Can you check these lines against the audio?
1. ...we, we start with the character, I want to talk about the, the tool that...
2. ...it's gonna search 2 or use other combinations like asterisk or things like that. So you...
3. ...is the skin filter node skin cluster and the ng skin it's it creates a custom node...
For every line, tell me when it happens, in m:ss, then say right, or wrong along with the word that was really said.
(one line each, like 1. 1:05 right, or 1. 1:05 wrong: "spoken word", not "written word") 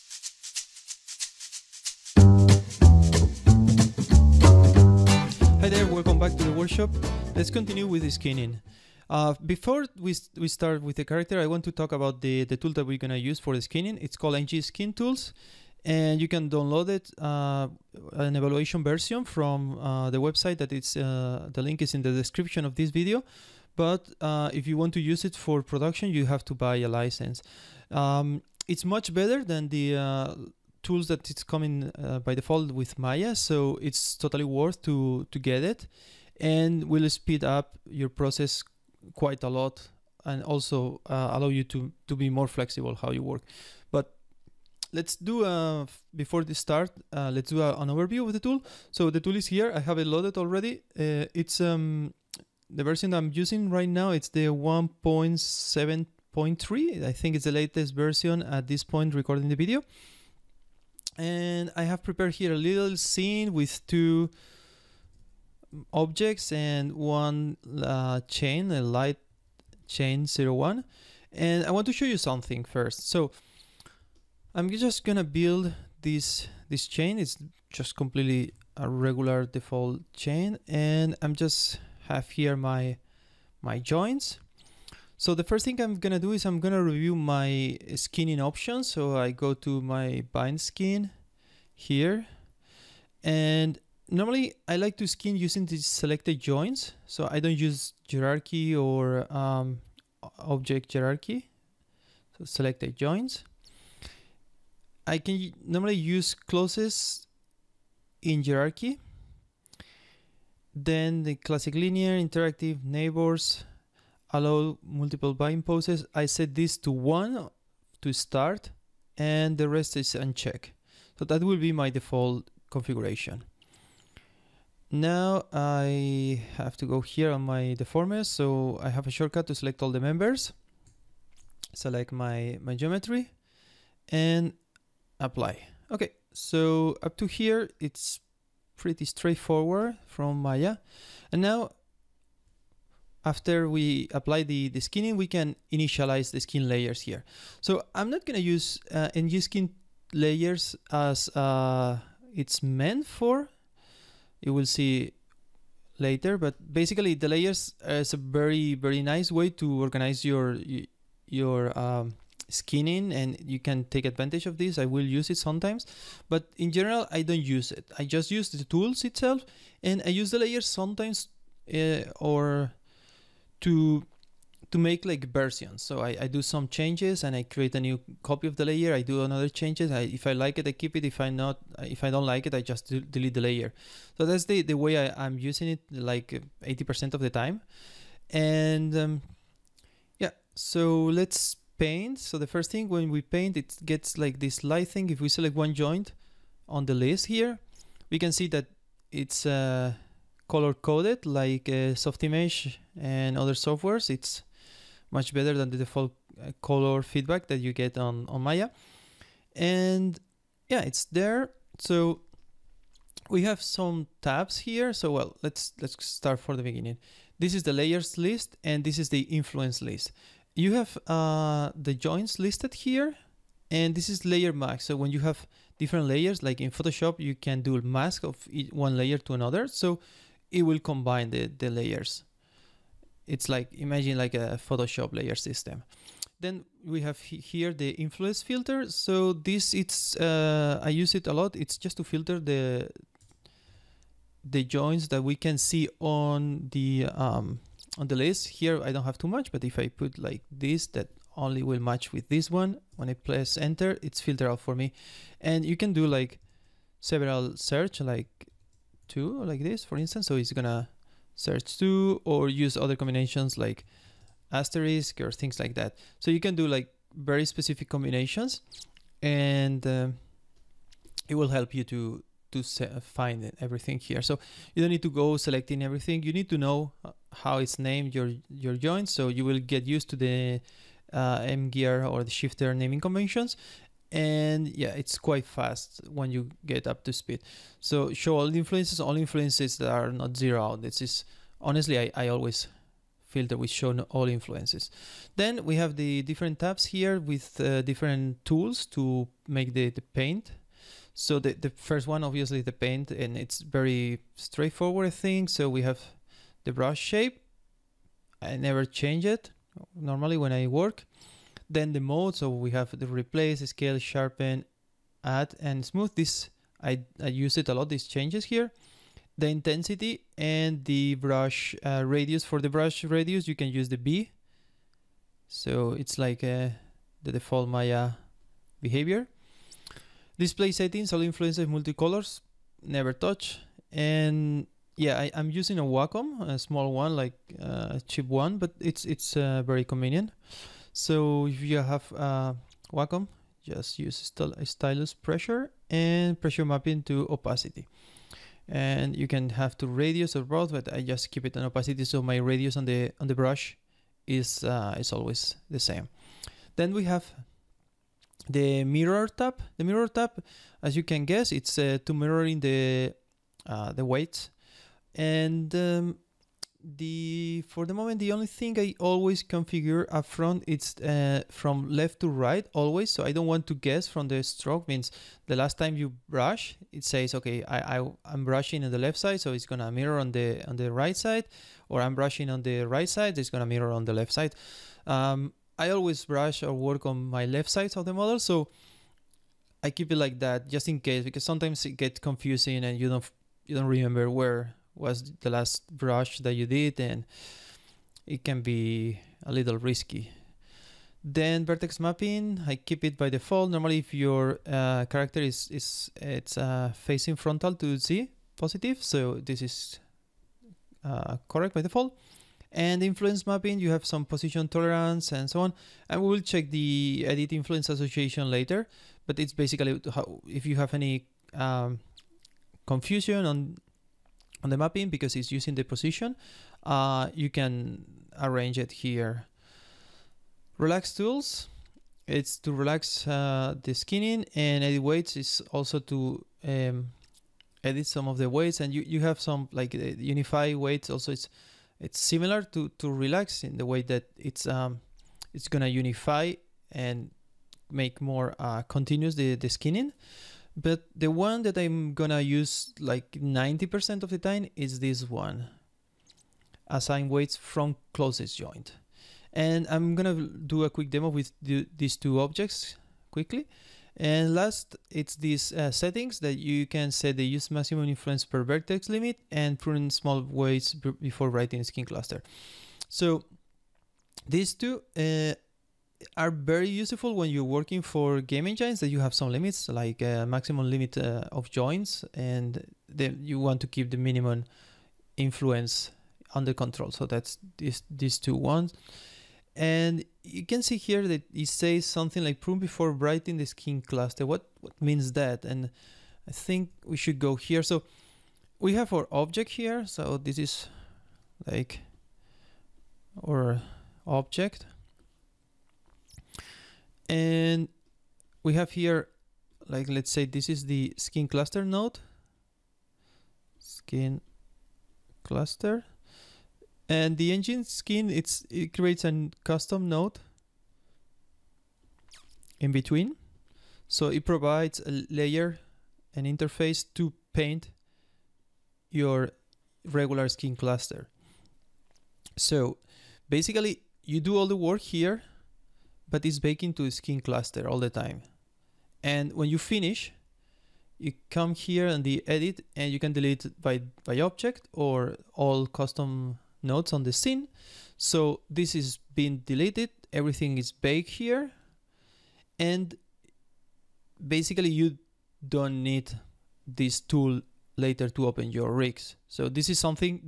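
1. 0:10 right
2. 4:20 right
3. 8:30 wrong: "cluster", not "filter".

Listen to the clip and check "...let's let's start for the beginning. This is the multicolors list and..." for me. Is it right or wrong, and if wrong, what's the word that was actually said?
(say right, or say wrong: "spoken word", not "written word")
wrong: "layers", not "multicolors".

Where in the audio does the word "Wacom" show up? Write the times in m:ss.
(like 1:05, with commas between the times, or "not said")
5:35, 5:42.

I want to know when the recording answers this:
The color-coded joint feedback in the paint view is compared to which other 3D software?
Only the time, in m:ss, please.
3:22.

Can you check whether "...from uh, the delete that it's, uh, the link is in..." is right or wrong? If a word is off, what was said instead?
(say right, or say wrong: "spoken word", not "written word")
wrong: "website", not "delete".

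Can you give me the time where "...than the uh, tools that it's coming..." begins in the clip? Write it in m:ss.
0:29.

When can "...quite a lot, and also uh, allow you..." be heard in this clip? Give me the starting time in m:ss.
0:39.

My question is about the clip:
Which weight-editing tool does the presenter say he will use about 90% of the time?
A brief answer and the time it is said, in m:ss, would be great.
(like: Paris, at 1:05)
Assign weights from closest joint, at 7:36.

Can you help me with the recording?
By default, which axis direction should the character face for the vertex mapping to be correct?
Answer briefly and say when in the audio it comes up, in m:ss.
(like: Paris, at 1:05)
z positive, at 6:47.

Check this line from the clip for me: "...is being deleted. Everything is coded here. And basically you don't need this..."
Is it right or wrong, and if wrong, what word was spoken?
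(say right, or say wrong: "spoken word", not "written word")
wrong: "baked", not "coded".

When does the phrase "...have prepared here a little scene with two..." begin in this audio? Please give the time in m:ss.
1:01.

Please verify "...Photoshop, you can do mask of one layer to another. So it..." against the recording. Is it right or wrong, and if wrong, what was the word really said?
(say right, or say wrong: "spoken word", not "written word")
right.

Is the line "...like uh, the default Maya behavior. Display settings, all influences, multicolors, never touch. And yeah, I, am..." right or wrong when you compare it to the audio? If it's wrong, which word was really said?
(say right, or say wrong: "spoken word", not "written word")
right.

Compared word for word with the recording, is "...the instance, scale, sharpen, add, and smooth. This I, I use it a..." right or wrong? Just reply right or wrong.
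wrong.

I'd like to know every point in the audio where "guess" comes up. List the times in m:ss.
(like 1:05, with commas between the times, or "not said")
6:01, 6:13.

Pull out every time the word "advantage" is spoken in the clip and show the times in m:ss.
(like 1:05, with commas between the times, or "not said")
2:44.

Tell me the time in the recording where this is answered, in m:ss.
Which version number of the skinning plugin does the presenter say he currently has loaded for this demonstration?
0:54.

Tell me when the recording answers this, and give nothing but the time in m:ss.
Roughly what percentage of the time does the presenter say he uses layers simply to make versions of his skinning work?
3:06.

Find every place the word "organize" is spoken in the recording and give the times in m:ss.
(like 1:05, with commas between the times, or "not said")
2:39.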